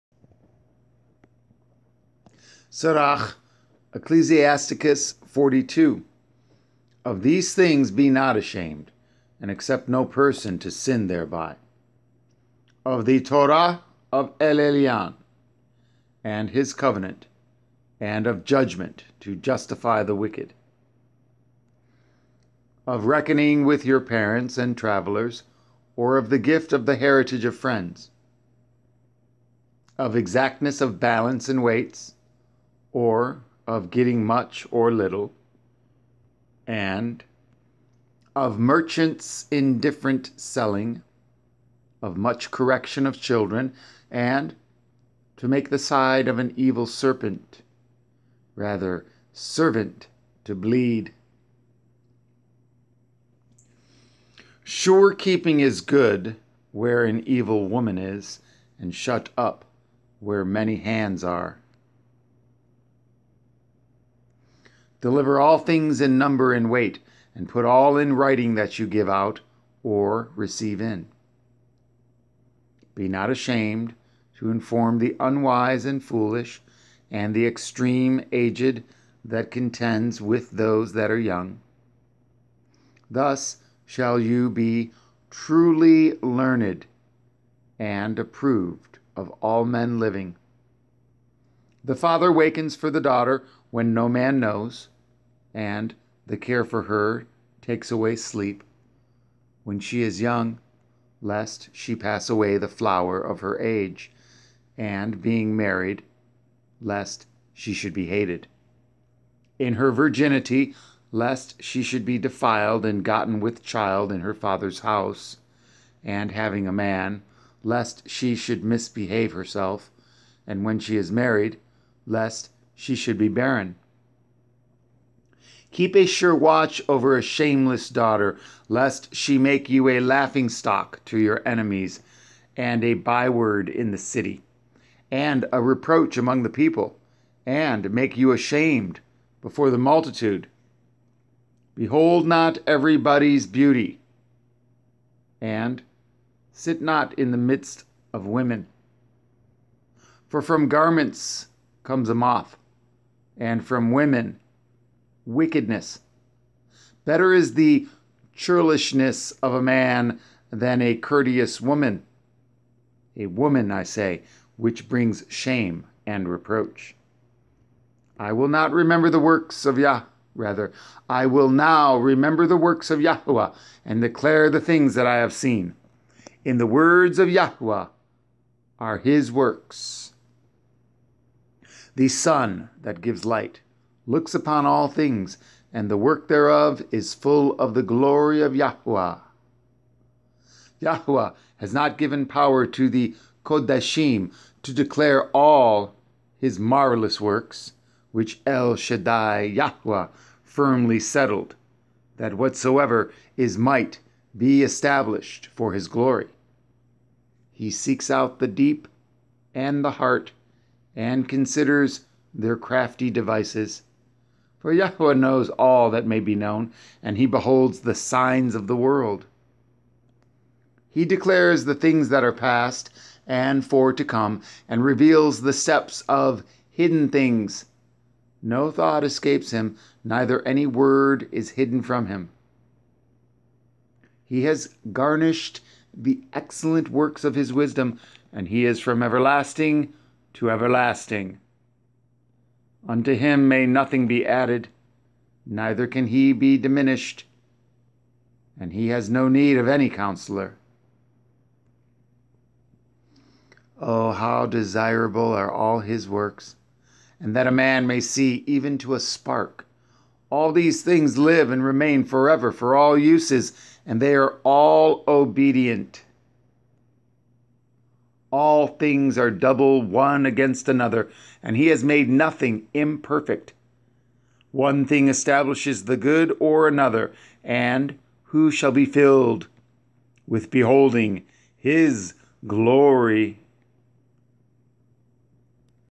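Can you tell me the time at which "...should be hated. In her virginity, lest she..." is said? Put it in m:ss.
1:47.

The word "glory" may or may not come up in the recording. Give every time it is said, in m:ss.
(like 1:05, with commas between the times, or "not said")
3:07, 3:25, 4:42.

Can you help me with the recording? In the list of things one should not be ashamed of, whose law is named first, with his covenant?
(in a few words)
El Elyon.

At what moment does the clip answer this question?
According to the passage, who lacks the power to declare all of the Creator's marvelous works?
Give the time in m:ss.
3:13.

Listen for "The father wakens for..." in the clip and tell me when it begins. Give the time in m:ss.
1:31.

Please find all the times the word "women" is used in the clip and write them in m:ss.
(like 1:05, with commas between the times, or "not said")
2:28, 2:33.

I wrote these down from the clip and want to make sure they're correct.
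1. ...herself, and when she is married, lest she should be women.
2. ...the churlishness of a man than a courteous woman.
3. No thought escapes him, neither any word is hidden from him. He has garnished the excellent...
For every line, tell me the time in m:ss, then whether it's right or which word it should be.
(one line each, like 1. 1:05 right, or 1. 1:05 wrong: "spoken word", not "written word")
1. 1:59 wrong: "barren", not "women"
2. 2:37 right
3. 3:48 right.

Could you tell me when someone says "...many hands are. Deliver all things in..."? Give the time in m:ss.
1:00.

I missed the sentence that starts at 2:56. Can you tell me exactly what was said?
In the words of Yahweh are his works.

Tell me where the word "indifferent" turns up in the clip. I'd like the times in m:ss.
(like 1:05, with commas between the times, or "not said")
0:39.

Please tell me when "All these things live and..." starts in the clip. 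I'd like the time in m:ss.
4:20.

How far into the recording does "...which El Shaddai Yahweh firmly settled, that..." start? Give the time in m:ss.
3:18.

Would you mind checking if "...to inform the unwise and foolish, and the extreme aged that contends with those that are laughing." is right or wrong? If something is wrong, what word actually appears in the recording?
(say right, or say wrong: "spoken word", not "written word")
wrong: "young", not "laughing".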